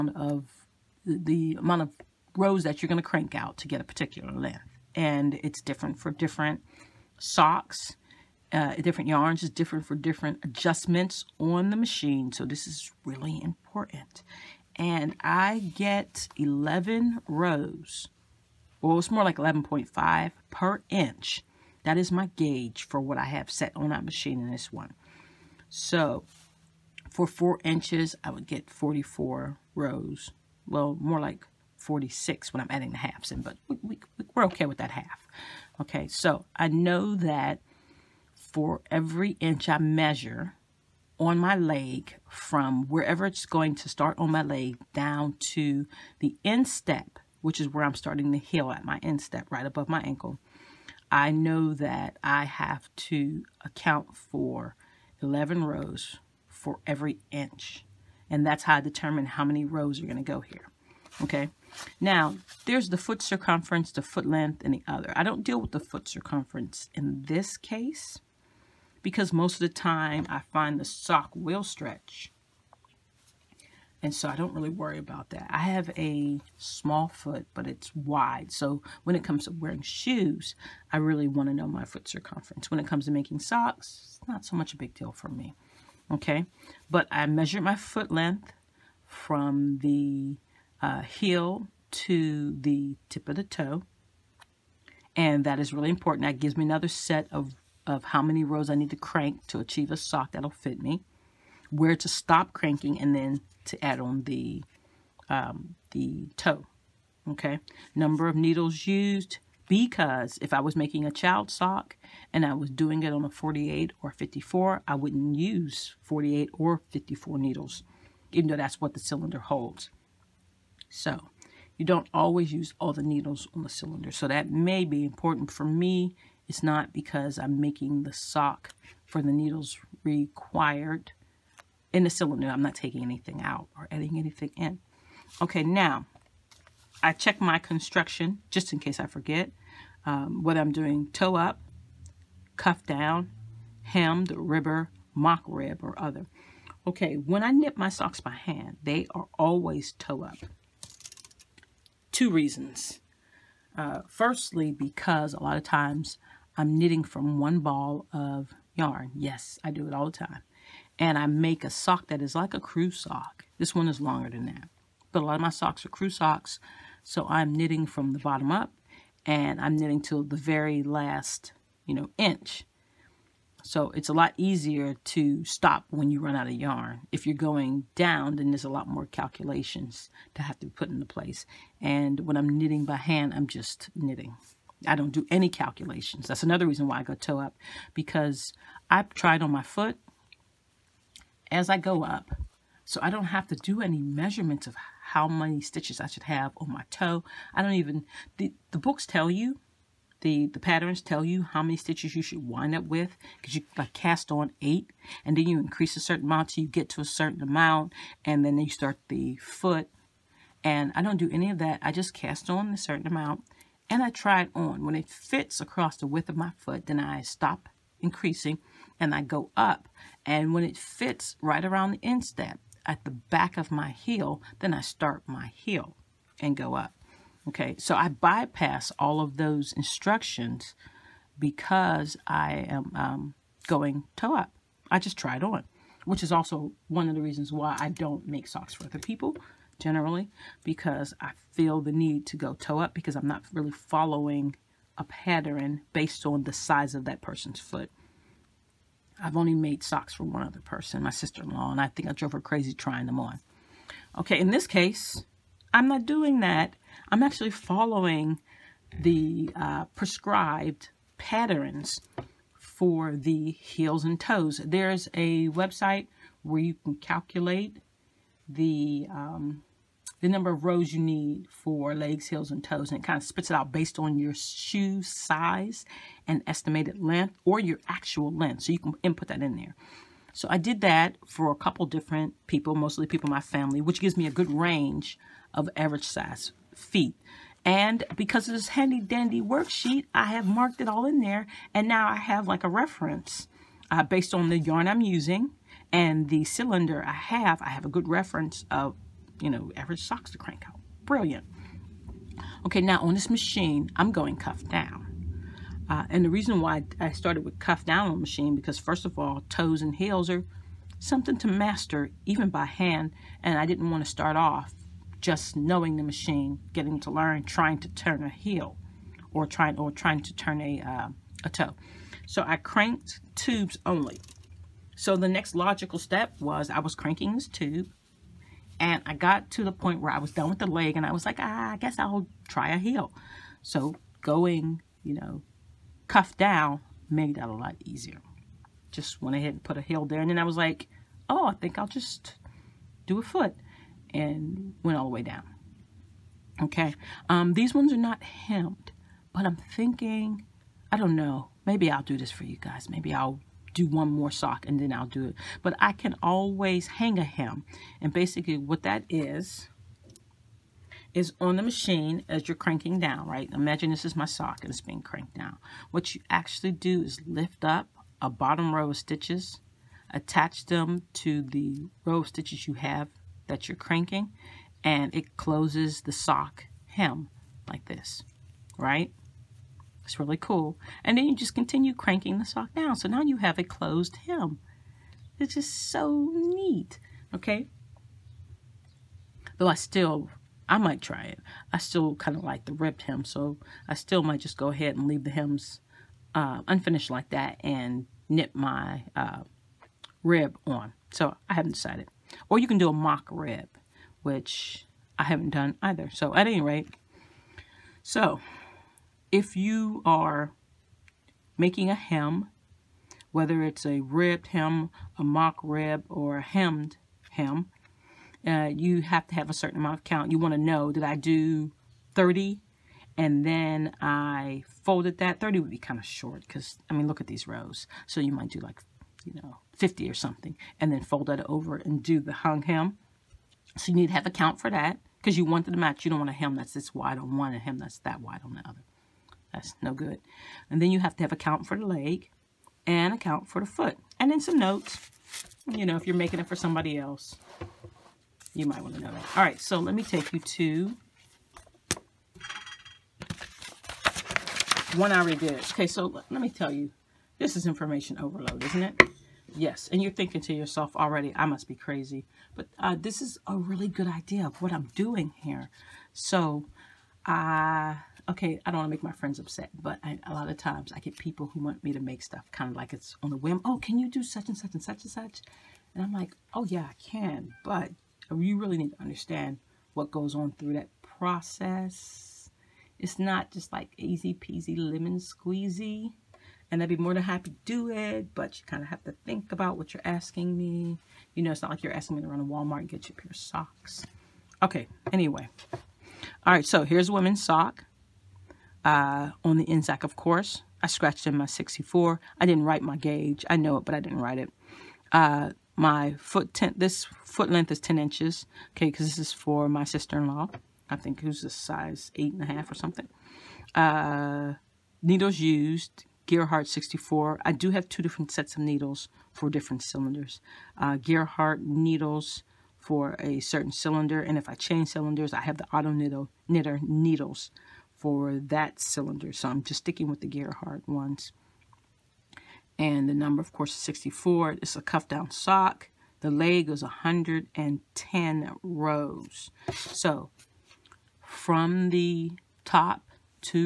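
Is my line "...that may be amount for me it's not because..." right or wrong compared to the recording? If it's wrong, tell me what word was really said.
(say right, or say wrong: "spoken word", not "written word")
wrong: "important", not "amount".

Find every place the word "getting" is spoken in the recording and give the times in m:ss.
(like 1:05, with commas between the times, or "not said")
5:16.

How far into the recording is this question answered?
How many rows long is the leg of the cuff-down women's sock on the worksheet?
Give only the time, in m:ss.
8:56.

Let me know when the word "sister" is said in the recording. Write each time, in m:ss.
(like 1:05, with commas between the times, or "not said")
4:11, 8:29.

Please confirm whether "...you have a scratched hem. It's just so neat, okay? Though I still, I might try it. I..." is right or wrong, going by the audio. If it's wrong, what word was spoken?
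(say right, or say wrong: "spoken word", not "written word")
wrong: "closed", not "scratched".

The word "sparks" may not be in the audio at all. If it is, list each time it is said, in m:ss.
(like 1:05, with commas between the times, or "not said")
not said.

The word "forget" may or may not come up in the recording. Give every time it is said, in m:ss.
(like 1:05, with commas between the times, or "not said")
2:19.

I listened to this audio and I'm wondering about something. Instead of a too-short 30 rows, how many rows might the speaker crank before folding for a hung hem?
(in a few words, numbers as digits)
50.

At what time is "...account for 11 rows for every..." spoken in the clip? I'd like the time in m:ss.
0:53.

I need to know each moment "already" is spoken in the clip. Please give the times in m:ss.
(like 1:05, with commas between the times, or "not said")
7:35, 7:40.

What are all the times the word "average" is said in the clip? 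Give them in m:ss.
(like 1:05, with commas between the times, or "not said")
4:45, 4:59.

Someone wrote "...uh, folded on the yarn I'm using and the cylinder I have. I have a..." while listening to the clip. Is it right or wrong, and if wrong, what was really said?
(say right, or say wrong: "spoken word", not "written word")
wrong: "based", not "folded".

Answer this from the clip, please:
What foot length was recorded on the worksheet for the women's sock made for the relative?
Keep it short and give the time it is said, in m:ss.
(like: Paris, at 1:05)
10 inches, at 8:27.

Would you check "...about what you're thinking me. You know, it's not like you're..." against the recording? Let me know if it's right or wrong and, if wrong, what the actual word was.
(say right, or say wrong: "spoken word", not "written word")
wrong: "asking", not "thinking".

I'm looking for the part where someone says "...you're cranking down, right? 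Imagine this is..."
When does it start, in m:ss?
6:02.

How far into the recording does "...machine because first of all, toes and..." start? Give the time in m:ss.
5:08.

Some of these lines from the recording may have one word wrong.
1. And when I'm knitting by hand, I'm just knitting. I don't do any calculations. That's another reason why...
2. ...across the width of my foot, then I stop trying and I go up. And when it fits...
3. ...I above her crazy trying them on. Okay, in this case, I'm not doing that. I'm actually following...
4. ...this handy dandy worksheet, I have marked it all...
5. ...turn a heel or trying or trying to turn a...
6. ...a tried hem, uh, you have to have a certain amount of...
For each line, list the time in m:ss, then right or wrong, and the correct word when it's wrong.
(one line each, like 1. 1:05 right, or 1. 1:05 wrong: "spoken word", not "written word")
1. 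3:01 right
2. 3:35 wrong: "increasing", not "trying"
3. 4:12 wrong: "drove", not "above"
4. 4:48 right
5. 5:17 right
6. 6:56 wrong: "hemmed", not "tried".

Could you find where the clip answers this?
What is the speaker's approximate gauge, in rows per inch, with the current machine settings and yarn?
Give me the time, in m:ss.
0:19.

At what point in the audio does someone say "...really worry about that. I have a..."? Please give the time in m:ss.
1:14.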